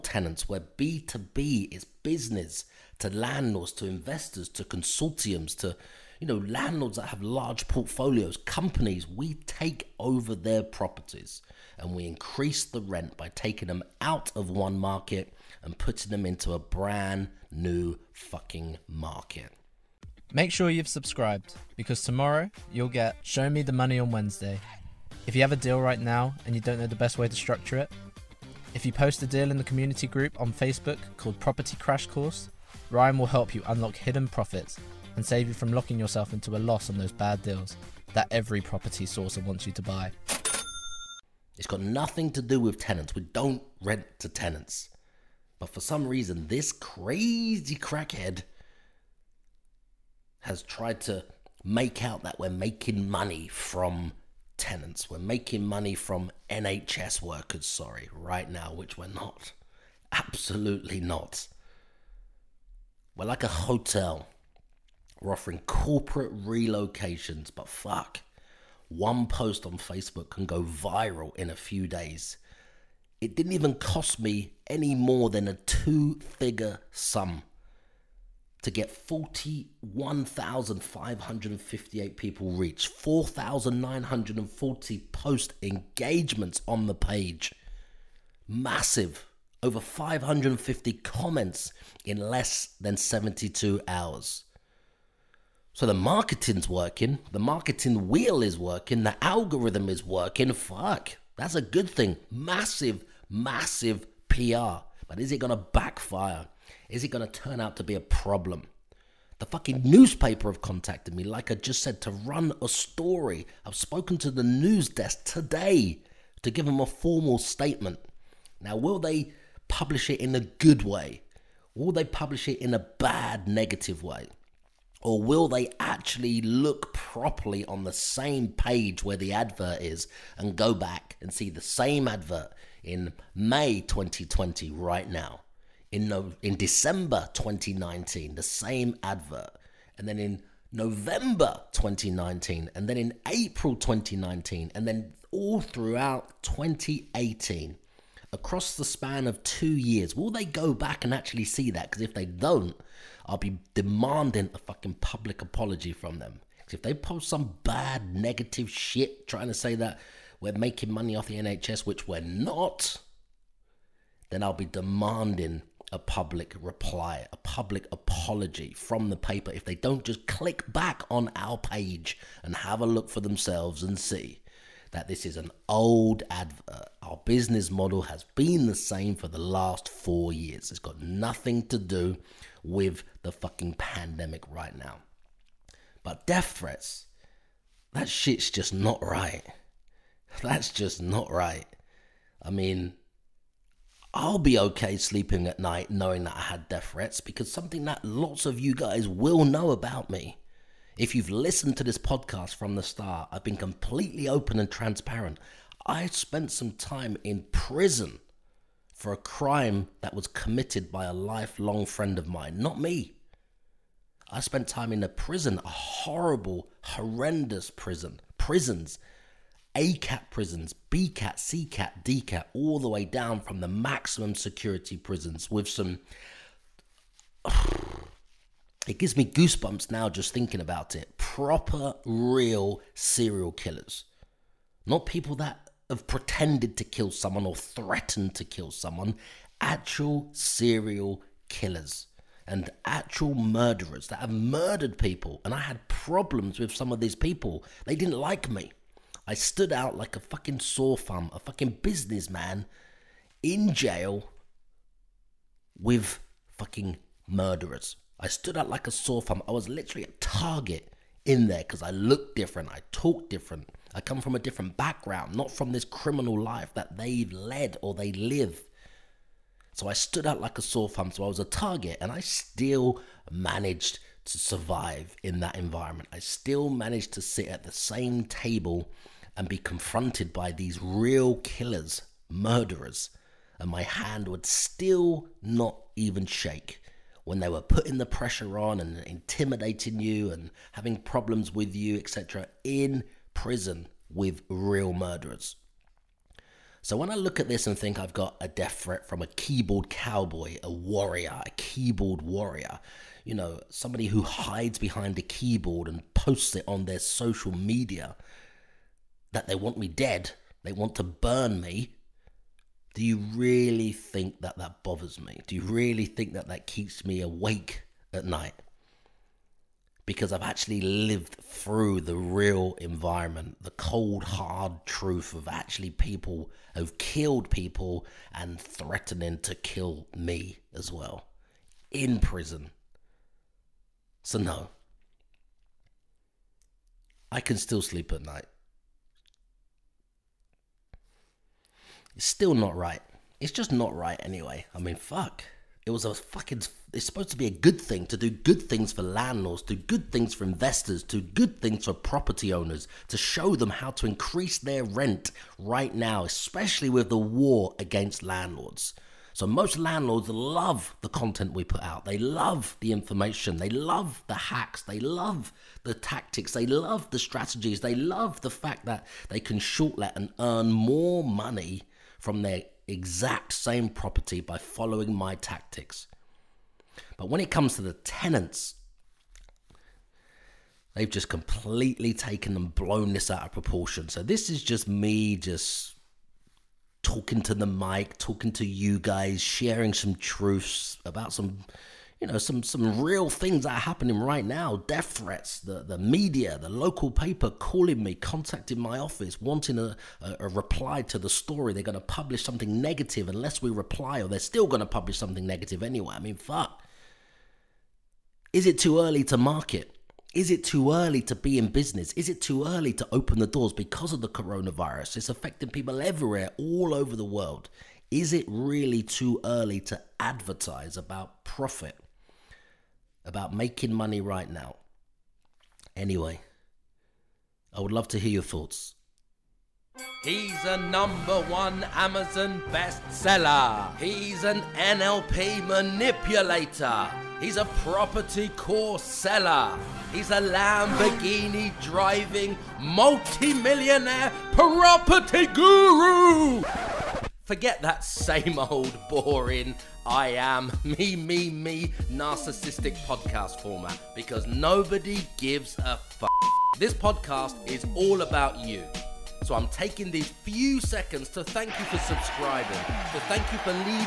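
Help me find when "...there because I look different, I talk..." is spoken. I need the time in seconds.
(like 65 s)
261 s.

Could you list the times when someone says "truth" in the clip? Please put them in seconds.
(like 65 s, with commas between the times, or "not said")
324 s, 390 s.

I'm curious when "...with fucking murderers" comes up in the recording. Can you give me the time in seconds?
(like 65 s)
255 s.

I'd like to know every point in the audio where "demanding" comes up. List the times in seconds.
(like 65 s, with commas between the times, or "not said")
153 s, 164 s.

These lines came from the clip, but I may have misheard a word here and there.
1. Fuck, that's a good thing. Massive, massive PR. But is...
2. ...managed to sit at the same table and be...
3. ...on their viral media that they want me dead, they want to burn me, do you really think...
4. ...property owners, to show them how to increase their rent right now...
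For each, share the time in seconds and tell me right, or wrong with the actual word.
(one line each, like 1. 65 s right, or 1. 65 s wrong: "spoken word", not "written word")
1. 100 s right
2. 276 s right
3. 306 s wrong: "social", not "viral"
4. 351 s right.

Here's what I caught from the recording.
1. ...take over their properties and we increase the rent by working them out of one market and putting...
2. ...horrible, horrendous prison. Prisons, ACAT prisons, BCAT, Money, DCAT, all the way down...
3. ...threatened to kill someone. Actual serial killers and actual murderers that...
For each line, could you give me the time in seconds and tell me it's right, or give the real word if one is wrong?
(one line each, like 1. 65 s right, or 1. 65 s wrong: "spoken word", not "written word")
1. 9 s wrong: "taking", not "working"
2. 215 s wrong: "CCAT", not "Money"
3. 237 s right.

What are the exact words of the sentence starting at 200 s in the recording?
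If you've listened to this podcast from the start, I've been completely open and transparent.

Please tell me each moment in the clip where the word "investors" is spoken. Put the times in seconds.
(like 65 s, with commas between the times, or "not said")
3 s, 350 s.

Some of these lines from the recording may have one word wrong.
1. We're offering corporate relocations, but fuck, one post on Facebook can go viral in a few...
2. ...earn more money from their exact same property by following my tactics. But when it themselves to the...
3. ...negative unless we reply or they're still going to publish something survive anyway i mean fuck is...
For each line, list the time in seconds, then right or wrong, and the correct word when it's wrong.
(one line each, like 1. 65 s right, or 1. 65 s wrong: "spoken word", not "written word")
1. 65 s right
2. 370 s wrong: "comes", not "themselves"
3. 402 s wrong: "negative", not "survive".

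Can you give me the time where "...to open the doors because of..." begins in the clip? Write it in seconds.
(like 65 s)
412 s.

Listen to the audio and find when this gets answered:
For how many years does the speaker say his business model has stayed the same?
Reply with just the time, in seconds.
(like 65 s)
179 s.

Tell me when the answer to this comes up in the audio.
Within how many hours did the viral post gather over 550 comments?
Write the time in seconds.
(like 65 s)
92 s.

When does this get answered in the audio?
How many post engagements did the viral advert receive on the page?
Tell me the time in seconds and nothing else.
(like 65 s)
82 s.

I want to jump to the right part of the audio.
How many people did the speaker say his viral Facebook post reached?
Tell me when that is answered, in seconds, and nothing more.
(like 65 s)
78 s.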